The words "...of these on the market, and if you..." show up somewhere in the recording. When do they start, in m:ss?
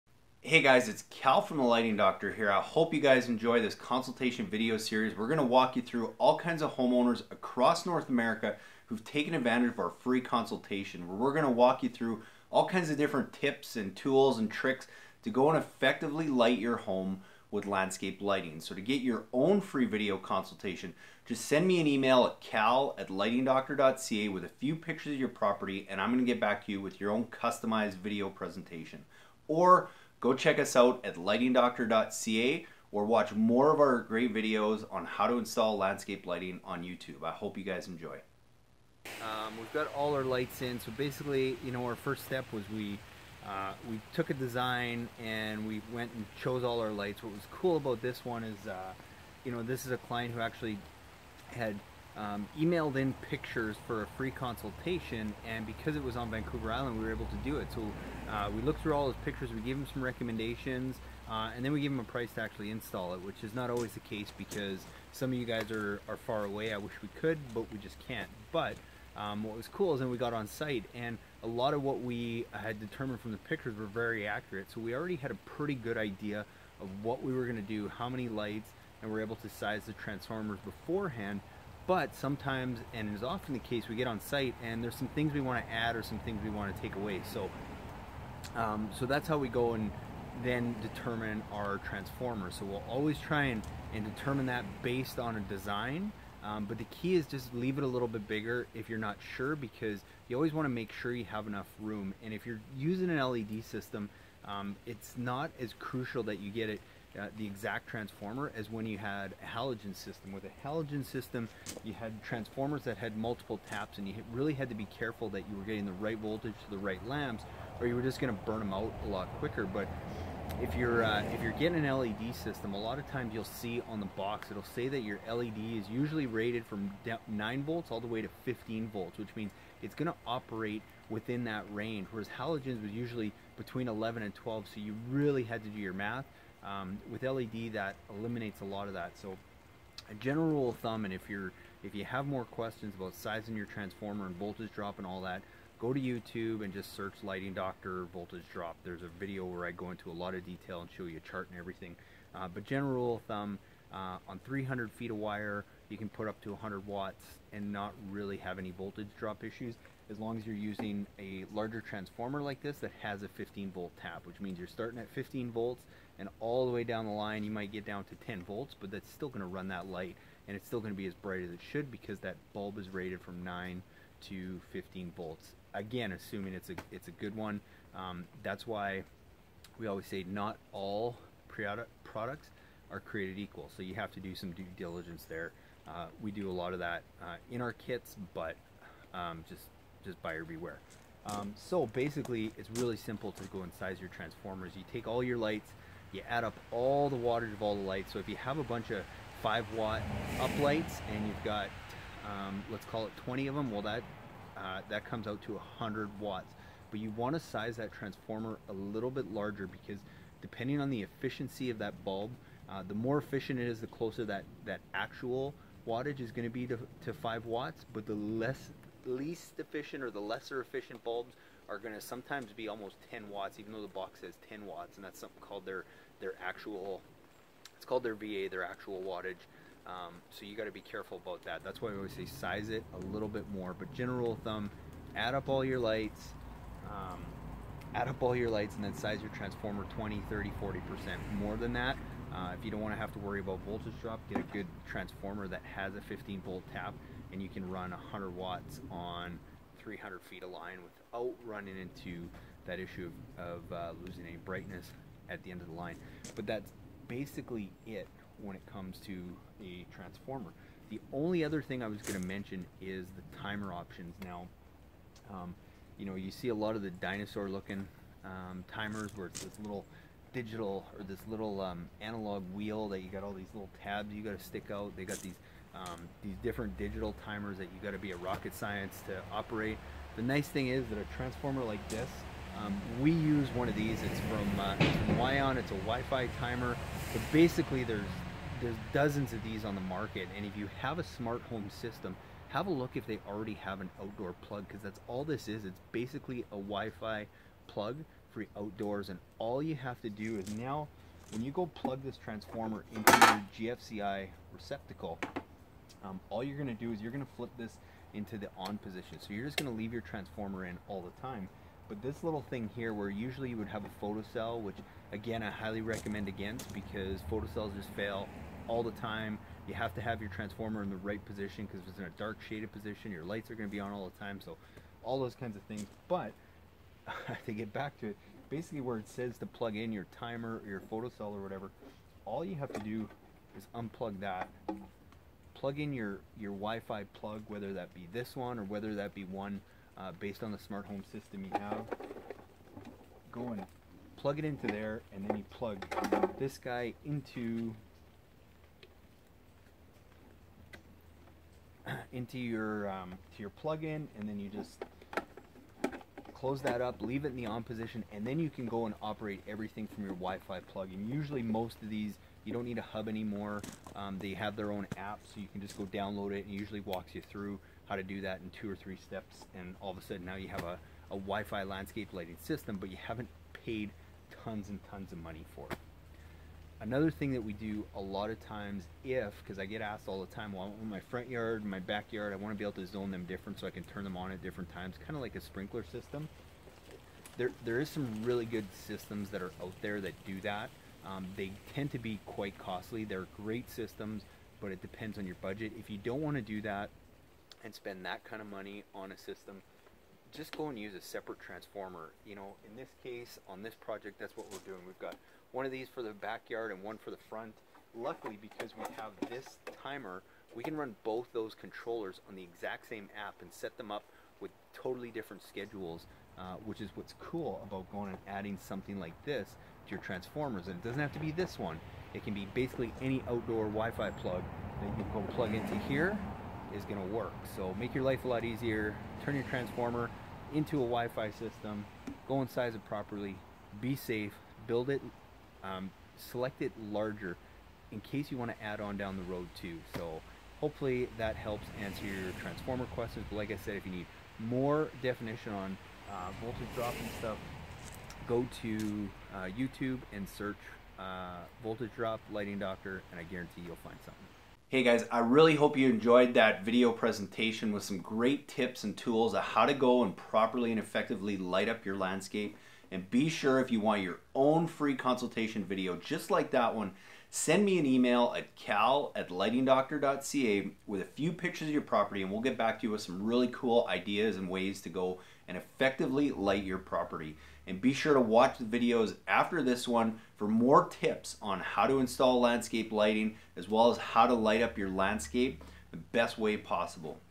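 4:49.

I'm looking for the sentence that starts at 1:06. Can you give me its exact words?
I wish we could, but we just can't.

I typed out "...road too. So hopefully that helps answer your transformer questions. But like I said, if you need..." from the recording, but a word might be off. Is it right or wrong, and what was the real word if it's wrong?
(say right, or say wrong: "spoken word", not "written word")
right.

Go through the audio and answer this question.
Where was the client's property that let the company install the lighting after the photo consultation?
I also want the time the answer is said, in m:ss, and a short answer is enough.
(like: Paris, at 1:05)
Vancouver Island, at 0:56.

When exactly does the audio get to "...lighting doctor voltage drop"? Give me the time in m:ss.
2:27.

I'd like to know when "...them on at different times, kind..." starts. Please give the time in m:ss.
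6:24.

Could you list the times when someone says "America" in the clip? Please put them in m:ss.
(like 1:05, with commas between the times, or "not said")
0:08.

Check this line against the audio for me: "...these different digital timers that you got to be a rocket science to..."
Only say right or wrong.
right.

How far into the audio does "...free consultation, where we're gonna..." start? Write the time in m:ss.
0:10.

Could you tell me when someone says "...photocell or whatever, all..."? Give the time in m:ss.
5:30.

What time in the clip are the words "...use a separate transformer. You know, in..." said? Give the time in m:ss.
6:40.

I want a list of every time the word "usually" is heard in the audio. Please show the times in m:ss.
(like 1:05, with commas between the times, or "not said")
2:05, 2:12, 5:13, 6:01, 6:06.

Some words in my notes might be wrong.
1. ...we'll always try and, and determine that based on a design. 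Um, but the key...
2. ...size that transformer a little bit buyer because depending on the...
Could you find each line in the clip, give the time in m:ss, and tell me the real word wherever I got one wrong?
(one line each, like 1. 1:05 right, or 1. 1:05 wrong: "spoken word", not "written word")
1. 1:32 right
2. 3:27 wrong: "larger", not "buyer".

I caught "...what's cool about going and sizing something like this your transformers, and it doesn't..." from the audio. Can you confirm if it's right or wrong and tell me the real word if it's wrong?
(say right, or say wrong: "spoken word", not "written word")
wrong: "adding", not "sizing".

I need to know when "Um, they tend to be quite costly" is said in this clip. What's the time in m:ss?
6:31.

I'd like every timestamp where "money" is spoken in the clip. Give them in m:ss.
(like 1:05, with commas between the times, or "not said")
6:15, 6:38.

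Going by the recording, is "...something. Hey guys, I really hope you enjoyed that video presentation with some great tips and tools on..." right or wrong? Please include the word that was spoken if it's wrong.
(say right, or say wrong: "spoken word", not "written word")
right.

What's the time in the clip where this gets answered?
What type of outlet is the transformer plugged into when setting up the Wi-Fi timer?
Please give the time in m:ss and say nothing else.
5:03.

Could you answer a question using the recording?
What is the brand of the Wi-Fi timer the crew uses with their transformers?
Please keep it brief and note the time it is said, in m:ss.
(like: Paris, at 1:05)
Wion, at 4:45.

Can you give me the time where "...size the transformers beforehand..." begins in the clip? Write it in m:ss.
1:19.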